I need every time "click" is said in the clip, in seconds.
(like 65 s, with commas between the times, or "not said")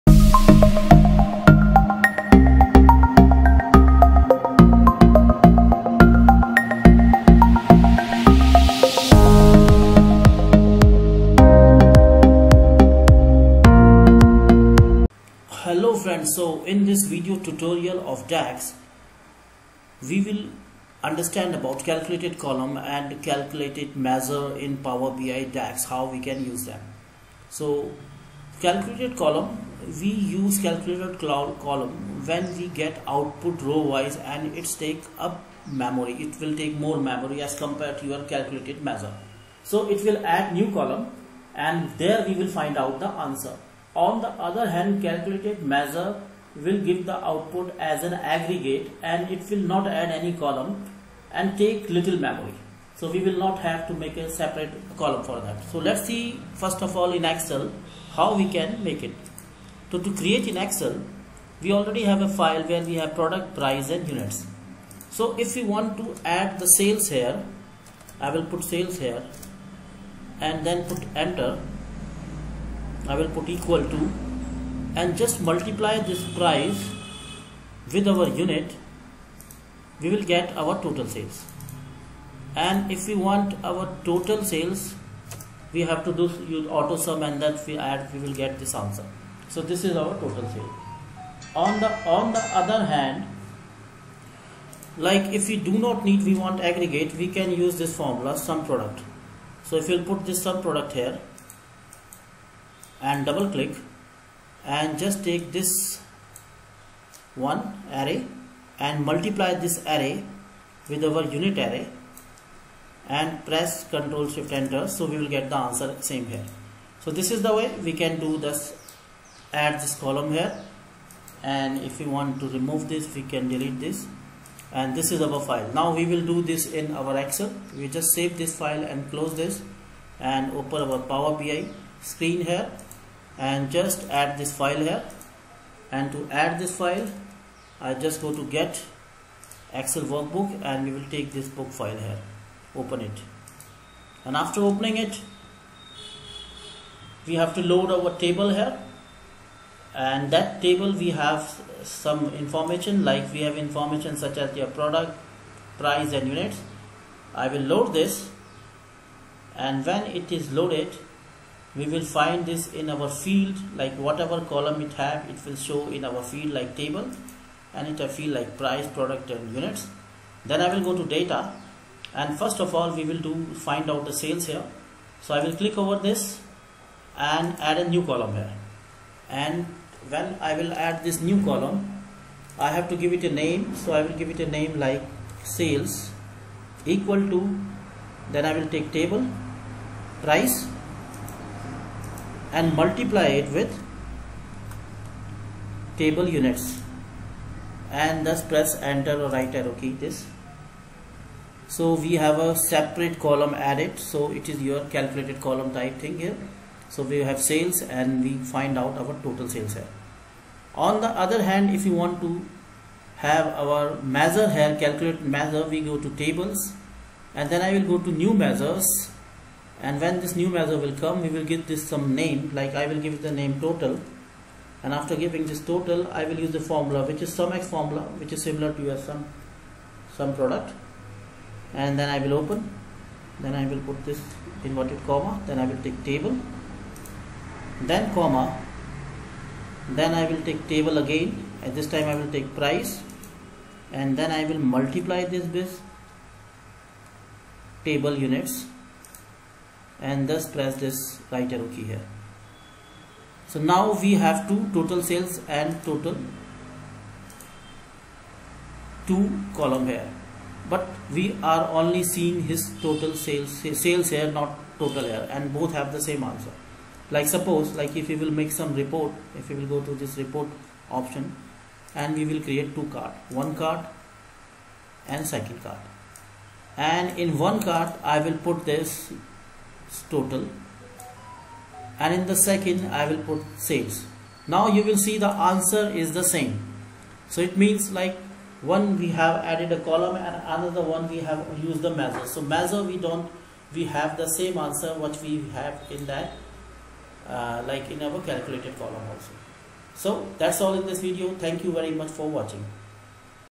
103 s, 175 s.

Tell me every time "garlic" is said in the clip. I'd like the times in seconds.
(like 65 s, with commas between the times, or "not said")
not said.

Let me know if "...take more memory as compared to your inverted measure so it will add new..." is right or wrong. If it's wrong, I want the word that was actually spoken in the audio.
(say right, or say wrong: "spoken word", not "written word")
wrong: "calculated", not "inverted".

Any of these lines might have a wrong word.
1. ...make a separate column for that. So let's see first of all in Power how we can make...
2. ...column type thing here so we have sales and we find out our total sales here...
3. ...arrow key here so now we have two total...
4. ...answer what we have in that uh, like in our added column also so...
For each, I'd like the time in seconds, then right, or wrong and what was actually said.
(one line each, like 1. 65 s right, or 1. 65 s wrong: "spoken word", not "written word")
1. 53 s wrong: "Excel", not "Power"
2. 205 s right
3. 251 s right
4. 294 s wrong: "calculated", not "added".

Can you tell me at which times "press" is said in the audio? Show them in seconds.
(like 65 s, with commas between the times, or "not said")
113 s, 198 s, 250 s.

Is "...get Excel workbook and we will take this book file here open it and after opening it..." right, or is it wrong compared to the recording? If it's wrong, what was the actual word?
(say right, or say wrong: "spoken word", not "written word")
right.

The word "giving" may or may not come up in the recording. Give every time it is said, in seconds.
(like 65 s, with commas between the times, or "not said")
225 s.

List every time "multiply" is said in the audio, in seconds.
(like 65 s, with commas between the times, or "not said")
75 s, 109 s, 192 s, 244 s.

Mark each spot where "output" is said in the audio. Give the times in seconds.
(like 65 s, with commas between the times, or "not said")
33 s, 47 s.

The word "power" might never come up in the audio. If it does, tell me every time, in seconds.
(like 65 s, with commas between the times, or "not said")
24 s, 131 s.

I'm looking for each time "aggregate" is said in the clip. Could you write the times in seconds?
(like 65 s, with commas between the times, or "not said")
48 s, 96 s.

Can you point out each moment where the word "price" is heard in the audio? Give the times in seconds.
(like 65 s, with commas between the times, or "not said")
63 s, 76 s, 155 s, 168 s, 190 s, 242 s.